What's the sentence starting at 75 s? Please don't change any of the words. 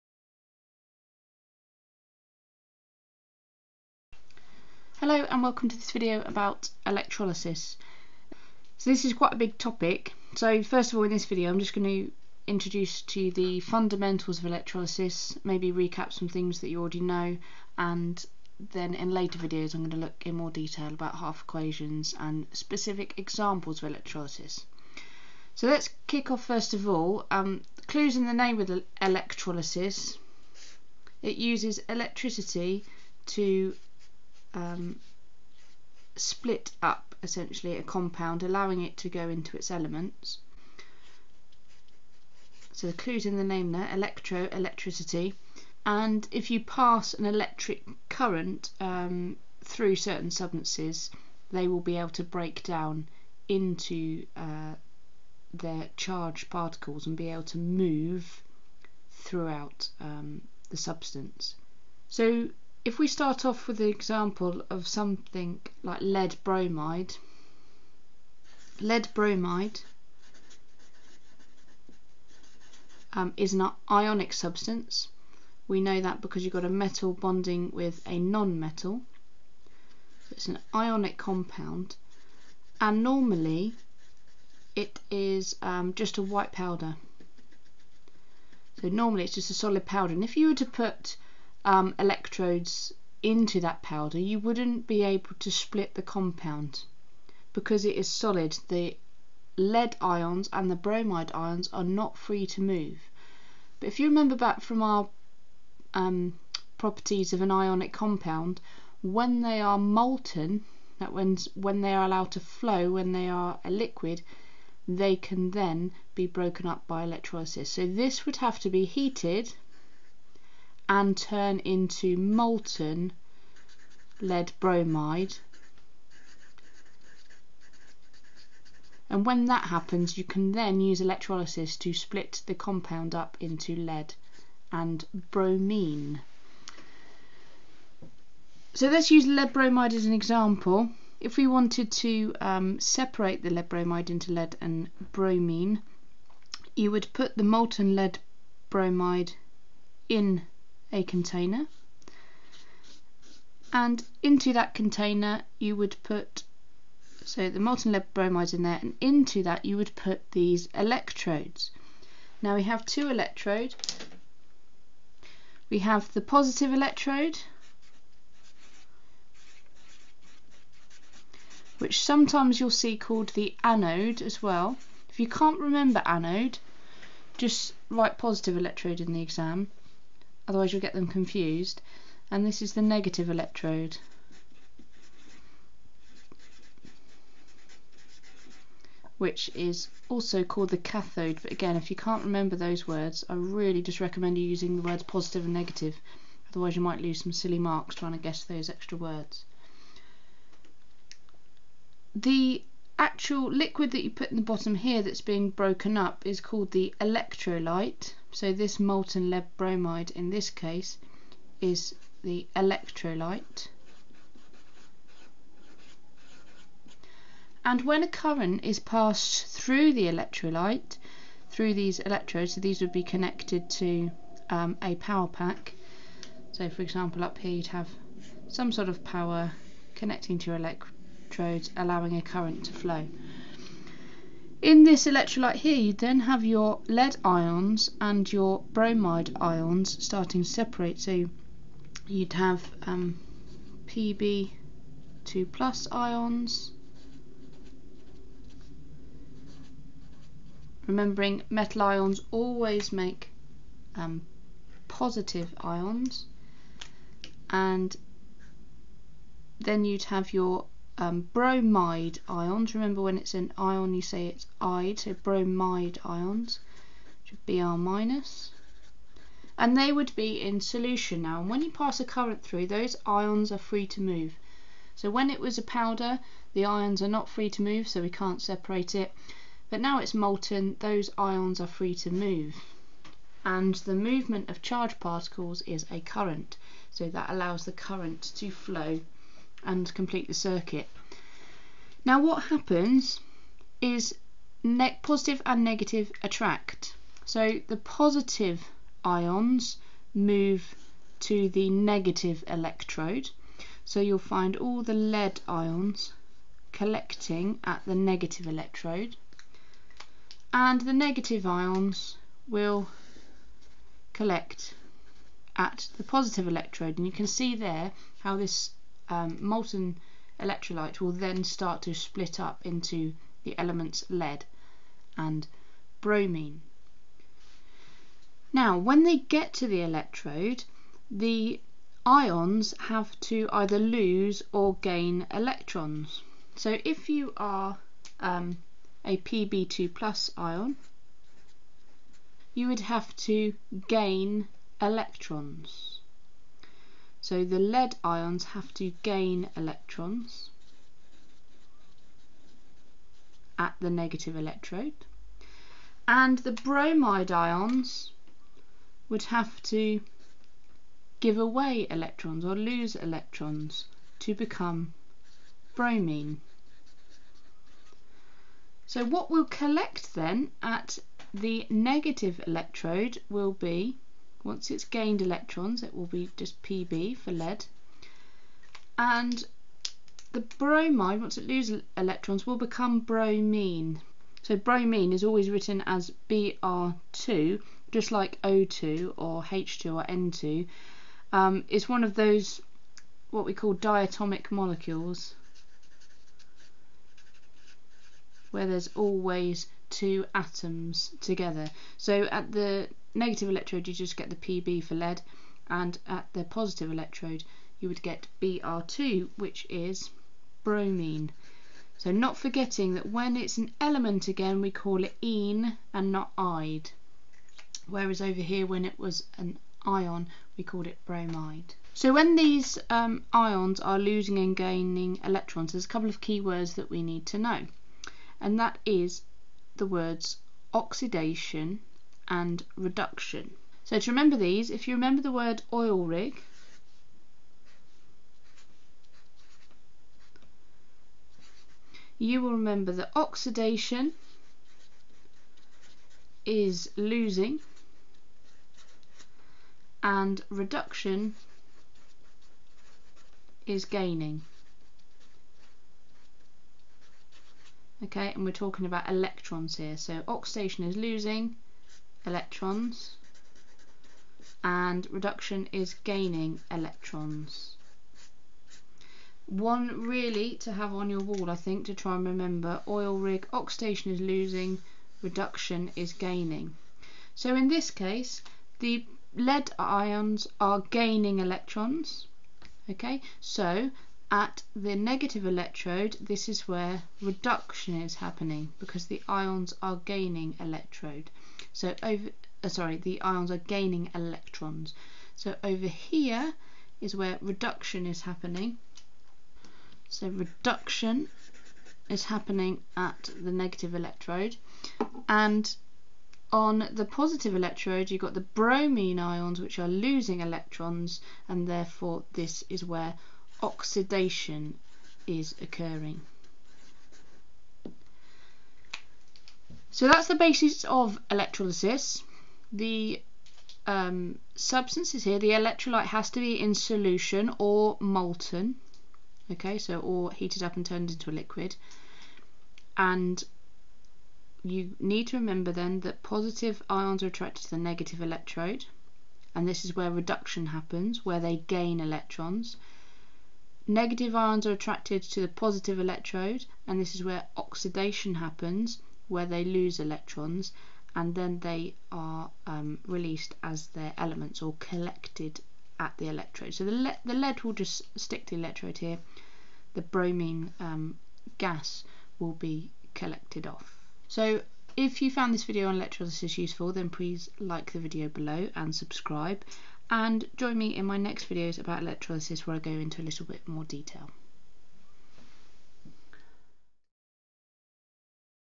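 We know that because you've got a metal bonding with a non-metal.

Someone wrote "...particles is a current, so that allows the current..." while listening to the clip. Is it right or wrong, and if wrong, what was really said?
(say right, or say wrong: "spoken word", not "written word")
right.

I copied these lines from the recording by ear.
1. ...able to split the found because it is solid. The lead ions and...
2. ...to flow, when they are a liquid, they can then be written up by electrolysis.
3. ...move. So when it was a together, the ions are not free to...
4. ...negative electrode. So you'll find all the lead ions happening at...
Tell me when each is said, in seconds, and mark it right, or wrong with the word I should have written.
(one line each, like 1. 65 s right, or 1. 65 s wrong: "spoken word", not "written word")
1. 95 s wrong: "compound", not "found"
2. 112 s wrong: "broken", not "written"
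3. 273 s wrong: "powder", not "together"
4. 301 s wrong: "collecting", not "happening".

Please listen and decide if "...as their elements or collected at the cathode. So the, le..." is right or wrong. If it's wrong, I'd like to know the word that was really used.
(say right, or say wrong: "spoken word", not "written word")
wrong: "electrode", not "cathode".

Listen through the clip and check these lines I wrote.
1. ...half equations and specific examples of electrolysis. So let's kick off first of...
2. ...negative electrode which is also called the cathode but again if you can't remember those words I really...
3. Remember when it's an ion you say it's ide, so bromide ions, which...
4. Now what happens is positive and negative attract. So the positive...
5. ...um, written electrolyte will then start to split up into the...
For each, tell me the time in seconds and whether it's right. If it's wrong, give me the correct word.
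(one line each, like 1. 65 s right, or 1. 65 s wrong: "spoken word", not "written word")
1. 21 s right
2. 182 s right
3. 262 s right
4. 292 s right
5. 319 s wrong: "molten", not "written".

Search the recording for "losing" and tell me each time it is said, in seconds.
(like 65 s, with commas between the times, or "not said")
423 s, 446 s, 460 s, 474 s, 509 s.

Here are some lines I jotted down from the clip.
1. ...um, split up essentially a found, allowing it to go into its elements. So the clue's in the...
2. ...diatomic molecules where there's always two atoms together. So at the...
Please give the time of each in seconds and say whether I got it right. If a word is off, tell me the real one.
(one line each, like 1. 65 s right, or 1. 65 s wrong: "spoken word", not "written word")
1. 34 s wrong: "compound", not "found"
2. 393 s right.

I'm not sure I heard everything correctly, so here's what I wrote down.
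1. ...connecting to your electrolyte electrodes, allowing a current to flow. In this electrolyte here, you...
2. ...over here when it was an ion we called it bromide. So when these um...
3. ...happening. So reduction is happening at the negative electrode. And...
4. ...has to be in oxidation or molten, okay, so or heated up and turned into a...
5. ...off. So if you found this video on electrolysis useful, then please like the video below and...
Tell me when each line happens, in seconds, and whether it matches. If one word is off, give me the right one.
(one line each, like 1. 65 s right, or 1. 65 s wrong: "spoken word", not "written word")
1. 229 s right
2. 418 s right
3. 498 s right
4. 526 s wrong: "solution", not "oxidation"
5. 563 s right.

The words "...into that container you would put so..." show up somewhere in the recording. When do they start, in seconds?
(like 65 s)
154 s.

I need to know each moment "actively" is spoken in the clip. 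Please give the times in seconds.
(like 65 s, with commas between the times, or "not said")
not said.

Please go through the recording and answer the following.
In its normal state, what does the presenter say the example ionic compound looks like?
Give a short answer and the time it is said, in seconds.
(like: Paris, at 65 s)
A white powder, at 86 s.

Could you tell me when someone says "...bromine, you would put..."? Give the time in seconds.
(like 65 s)
145 s.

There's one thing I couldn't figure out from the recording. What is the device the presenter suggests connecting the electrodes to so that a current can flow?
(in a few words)
A power pack.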